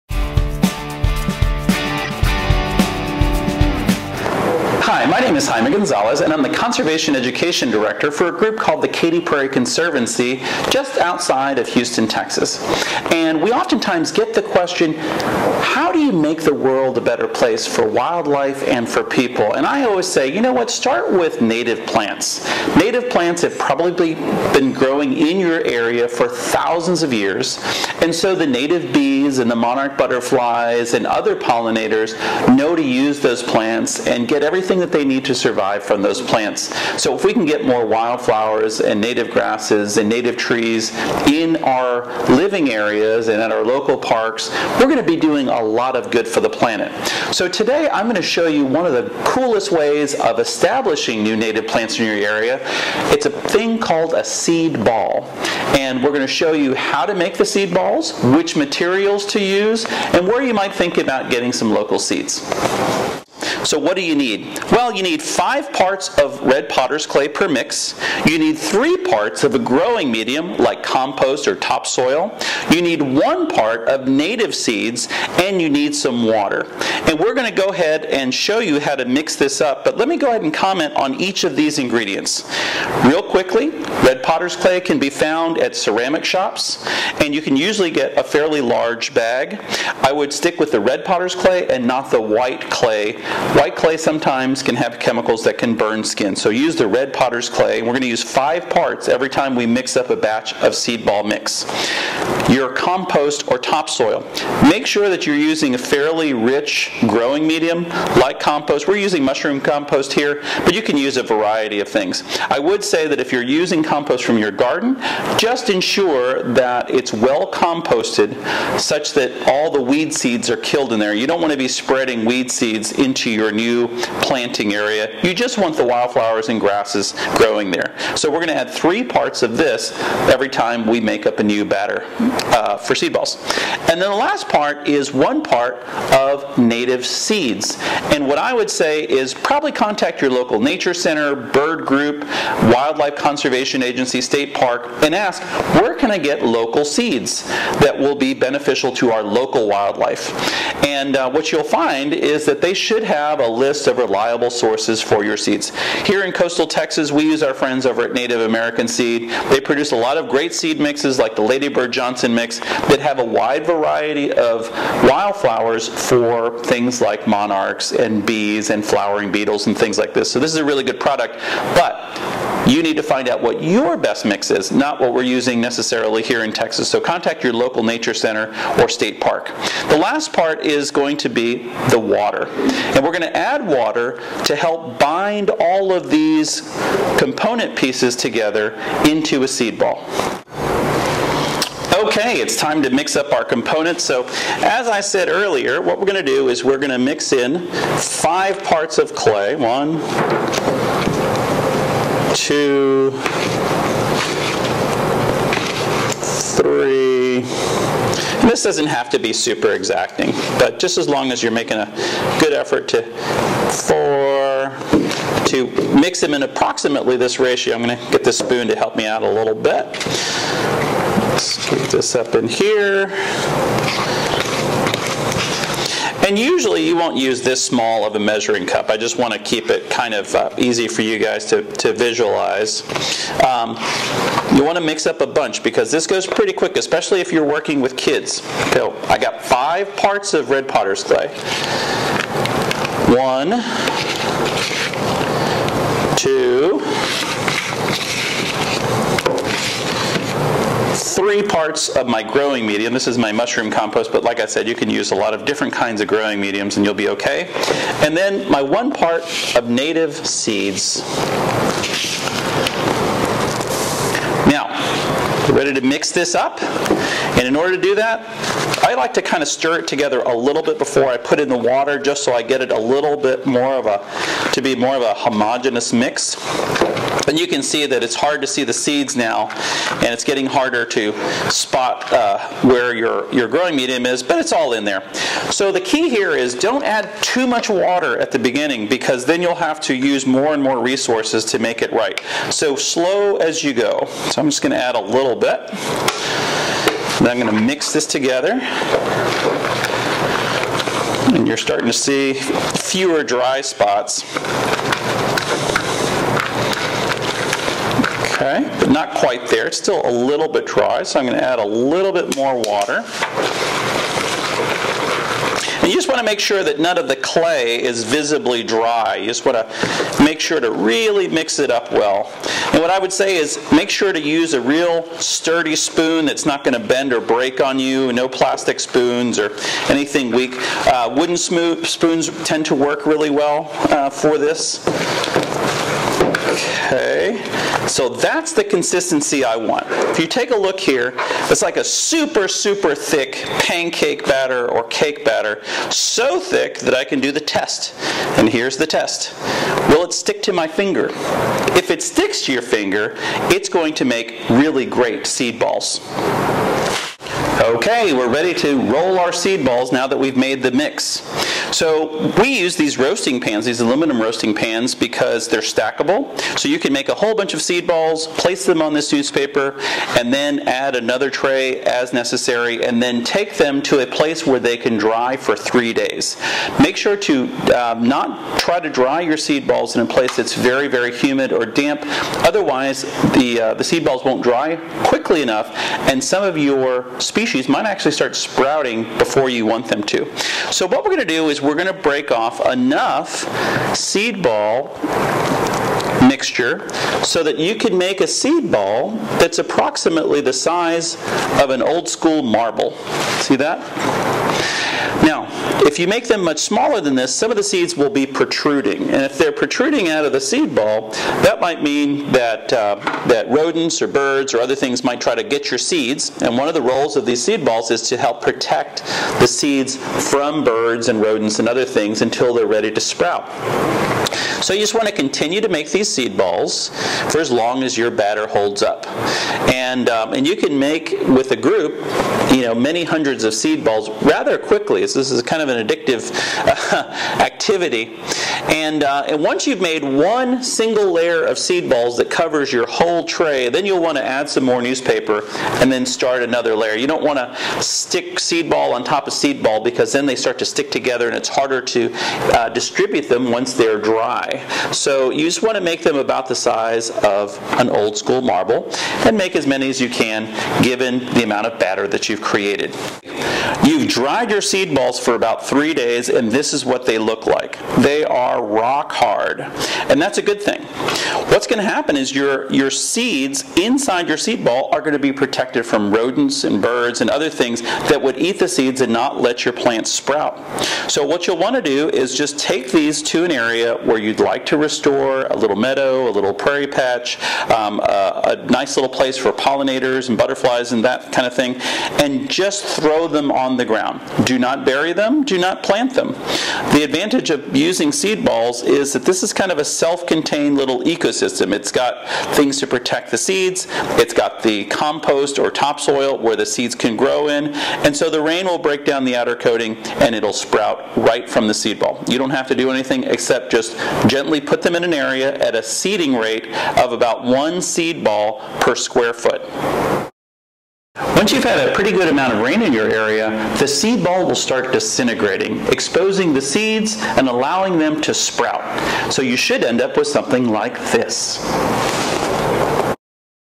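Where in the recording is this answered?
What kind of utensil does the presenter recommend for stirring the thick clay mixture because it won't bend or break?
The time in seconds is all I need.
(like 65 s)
331 s.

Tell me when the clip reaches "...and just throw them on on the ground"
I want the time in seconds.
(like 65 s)
492 s.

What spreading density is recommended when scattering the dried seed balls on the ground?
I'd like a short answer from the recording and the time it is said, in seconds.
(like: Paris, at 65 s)
1 seed ball per square foot, at 517 s.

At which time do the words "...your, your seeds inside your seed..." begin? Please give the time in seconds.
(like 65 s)
472 s.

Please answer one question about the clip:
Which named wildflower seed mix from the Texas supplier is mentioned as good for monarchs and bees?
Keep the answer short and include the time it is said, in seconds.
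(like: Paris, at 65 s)
Ladybird Johnson mix, at 161 s.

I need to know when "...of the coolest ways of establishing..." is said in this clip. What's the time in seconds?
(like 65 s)
48 s.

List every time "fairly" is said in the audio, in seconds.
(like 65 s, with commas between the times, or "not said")
88 s, 105 s.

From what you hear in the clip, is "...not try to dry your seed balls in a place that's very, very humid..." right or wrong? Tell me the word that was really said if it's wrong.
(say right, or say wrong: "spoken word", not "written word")
right.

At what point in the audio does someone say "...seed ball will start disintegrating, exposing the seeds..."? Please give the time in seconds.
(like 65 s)
523 s.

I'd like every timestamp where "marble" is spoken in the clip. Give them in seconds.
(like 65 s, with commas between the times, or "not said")
402 s, 458 s.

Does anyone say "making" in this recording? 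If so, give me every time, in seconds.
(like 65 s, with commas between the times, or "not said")
211 s.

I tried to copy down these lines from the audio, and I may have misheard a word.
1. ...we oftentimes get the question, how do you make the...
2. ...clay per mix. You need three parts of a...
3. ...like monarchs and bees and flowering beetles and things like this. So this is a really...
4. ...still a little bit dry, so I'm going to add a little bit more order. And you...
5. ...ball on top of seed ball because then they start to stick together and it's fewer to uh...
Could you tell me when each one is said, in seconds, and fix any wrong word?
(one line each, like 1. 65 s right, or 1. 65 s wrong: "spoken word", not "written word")
1. 13 s right
2. 67 s right
3. 166 s right
4. 309 s wrong: "water", not "order"
5. 448 s wrong: "harder", not "fewer".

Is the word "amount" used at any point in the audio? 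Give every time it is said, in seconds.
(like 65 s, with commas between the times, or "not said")
461 s, 522 s.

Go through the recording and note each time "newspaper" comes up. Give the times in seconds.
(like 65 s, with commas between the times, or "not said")
369 s, 444 s.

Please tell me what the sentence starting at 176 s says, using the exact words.
So contact your local nature center or state park.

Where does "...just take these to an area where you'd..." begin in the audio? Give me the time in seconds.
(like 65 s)
482 s.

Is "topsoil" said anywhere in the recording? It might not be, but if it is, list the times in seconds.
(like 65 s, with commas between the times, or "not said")
71 s, 103 s, 505 s.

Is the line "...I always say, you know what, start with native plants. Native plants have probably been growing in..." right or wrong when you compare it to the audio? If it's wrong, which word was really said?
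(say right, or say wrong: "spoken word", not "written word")
right.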